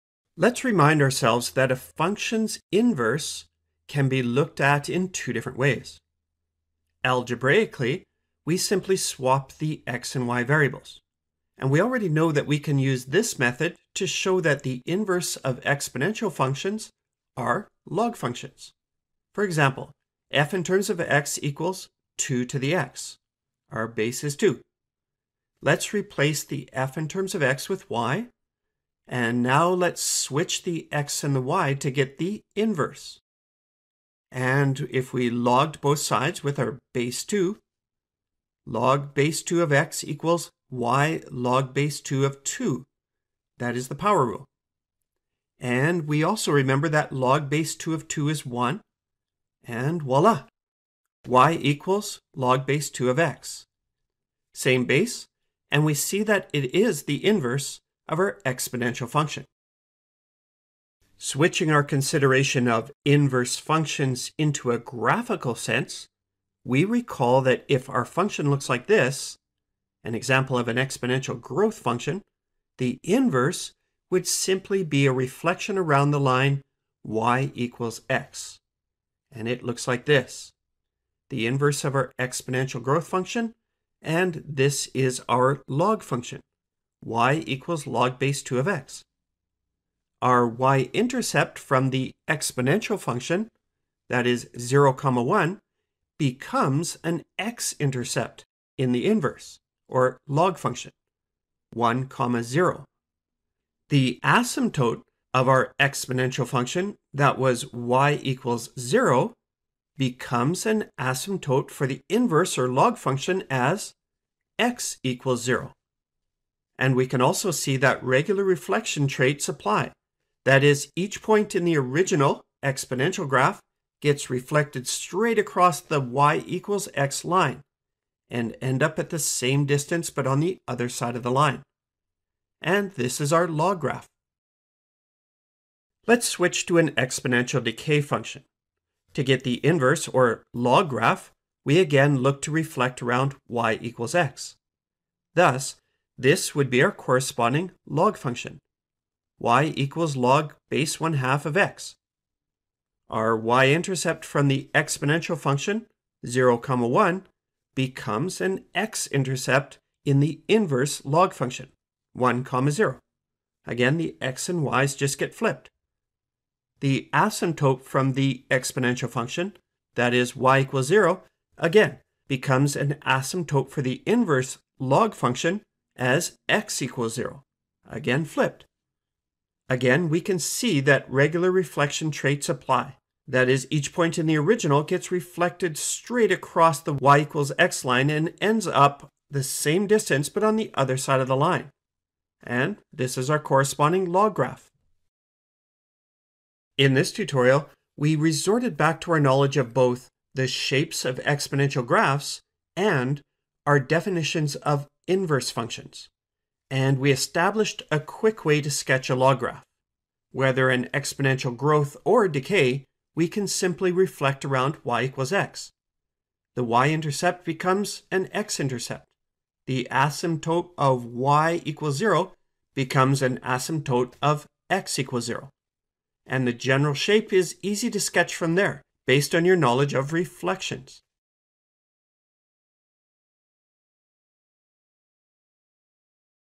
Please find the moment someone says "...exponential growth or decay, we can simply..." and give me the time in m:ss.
3:30.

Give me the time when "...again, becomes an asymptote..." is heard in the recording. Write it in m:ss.
2:51.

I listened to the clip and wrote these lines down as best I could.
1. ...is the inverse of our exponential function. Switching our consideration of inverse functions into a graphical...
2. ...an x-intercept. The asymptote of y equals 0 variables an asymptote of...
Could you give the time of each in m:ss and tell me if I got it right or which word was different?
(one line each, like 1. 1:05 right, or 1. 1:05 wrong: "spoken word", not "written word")
1. 0:56 right
2. 3:38 wrong: "becomes", not "variables".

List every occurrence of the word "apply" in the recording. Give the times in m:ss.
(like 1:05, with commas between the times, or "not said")
1:59, 3:02.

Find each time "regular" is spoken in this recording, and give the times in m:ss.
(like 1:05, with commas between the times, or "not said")
1:58, 3:01.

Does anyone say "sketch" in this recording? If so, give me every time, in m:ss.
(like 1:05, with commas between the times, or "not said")
3:28, 3:47.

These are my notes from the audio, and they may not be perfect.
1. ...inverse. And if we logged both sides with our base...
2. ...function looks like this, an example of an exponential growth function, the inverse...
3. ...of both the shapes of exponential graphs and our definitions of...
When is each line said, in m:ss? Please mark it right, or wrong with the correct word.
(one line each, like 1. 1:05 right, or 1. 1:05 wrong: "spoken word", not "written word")
1. 0:32 right
2. 1:08 right
3. 3:19 right.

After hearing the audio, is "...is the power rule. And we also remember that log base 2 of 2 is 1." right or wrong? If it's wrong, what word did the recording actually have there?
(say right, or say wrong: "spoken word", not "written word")
right.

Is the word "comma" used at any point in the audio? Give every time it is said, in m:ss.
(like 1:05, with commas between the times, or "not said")
1:34, 1:42, 2:36, 2:42.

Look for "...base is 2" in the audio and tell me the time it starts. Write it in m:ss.
0:23.